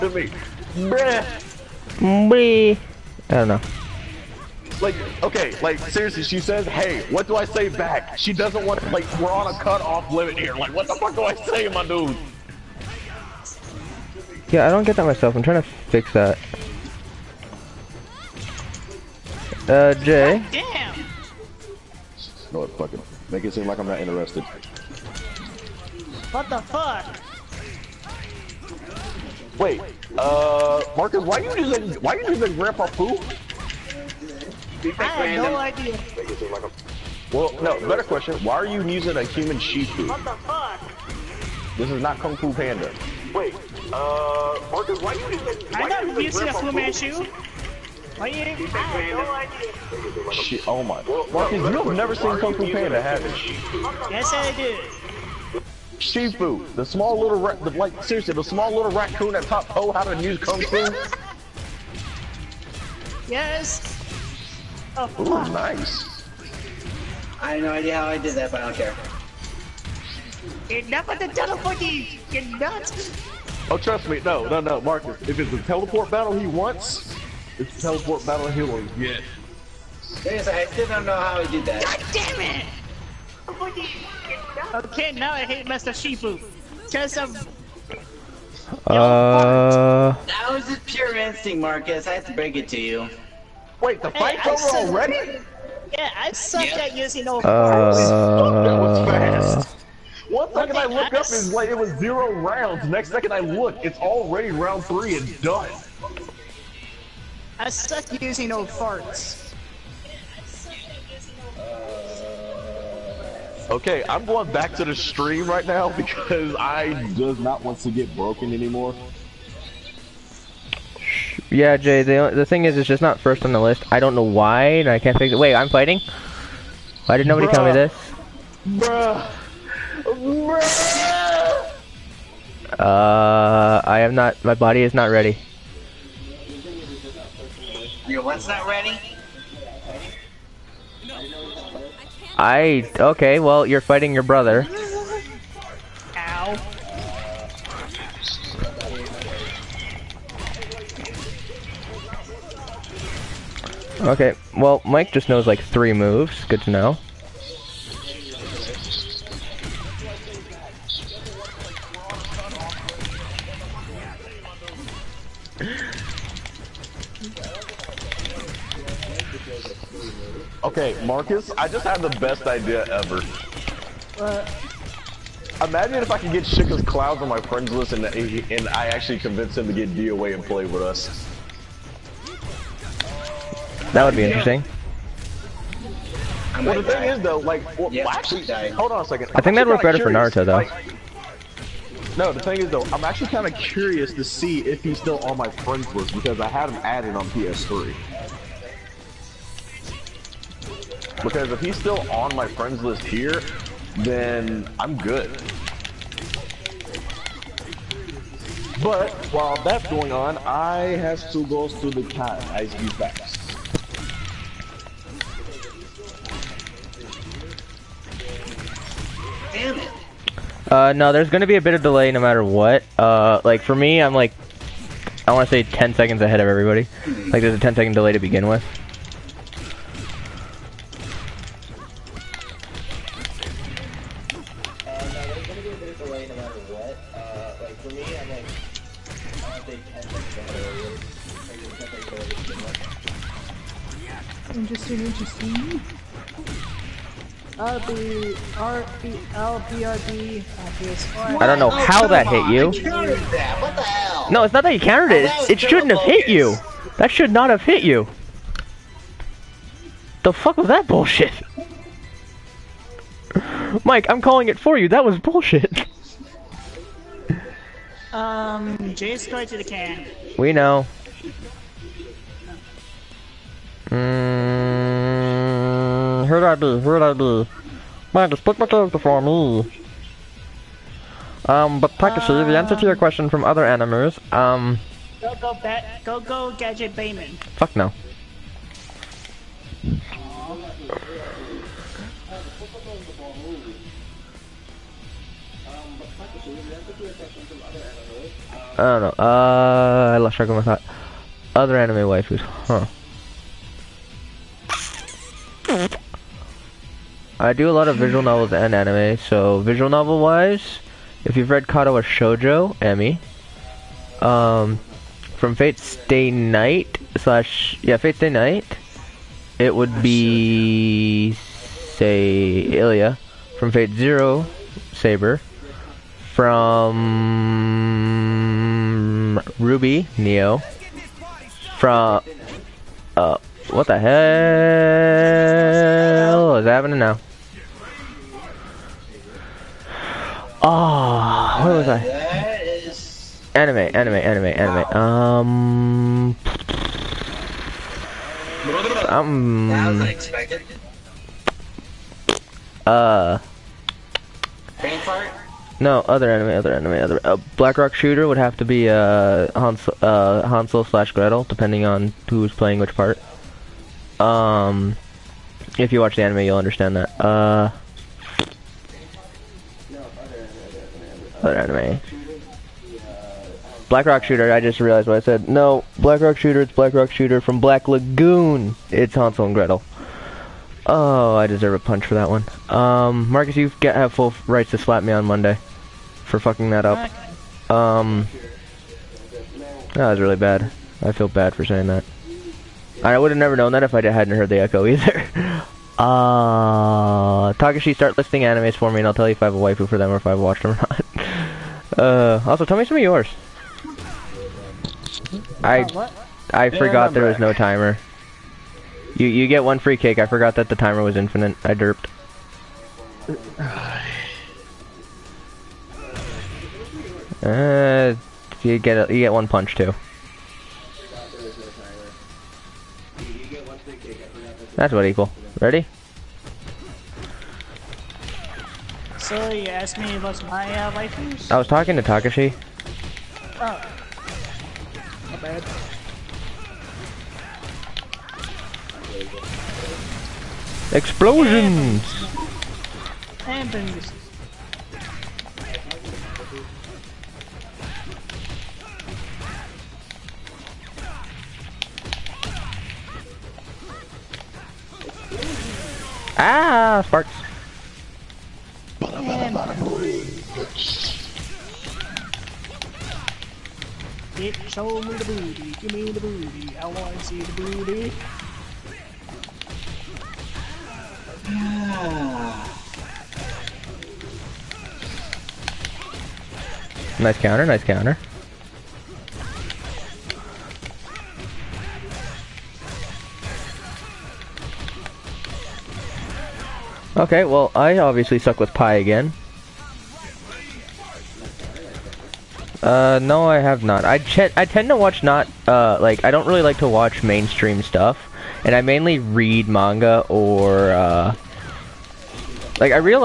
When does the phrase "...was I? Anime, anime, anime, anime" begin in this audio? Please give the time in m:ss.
5:41.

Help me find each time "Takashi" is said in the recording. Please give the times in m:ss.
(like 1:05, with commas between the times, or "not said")
4:41, 6:37, 7:12.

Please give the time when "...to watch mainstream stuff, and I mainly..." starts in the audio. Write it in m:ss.
8:16.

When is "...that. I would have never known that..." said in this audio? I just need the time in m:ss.
6:31.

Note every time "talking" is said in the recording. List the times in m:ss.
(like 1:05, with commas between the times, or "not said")
7:11.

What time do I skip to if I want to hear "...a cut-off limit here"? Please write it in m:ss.
0:09.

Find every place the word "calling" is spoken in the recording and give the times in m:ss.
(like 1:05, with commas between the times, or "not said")
4:24.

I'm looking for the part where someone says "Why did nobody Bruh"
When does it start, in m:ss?
2:07.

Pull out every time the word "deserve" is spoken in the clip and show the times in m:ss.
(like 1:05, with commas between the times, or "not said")
6:21.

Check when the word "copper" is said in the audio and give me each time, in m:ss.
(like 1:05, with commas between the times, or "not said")
not said.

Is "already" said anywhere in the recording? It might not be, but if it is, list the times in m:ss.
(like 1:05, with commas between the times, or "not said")
1:34, 1:43.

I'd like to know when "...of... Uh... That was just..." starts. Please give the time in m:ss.
1:27.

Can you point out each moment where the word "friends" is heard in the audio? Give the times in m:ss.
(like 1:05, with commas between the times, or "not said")
2:57, 3:15, 3:22.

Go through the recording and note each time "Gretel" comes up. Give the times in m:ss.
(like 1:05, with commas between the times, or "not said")
6:01, 6:19.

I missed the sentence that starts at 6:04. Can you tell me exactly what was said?
Um, if you watch the anime, you'll understand that.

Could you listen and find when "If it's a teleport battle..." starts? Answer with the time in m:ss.
1:15.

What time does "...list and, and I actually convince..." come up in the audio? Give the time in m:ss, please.
2:57.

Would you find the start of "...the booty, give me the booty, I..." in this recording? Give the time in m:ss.
7:45.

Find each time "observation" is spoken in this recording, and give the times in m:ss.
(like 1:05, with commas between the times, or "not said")
not said.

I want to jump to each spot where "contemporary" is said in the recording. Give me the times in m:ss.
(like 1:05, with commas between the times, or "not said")
not said.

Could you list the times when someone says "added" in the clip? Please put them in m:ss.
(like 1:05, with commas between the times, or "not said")
3:16.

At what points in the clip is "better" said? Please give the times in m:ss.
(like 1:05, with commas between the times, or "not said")
0:37, 3:09.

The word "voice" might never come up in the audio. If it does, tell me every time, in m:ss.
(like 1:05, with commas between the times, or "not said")
not said.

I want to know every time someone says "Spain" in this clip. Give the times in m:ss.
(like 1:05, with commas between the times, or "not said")
not said.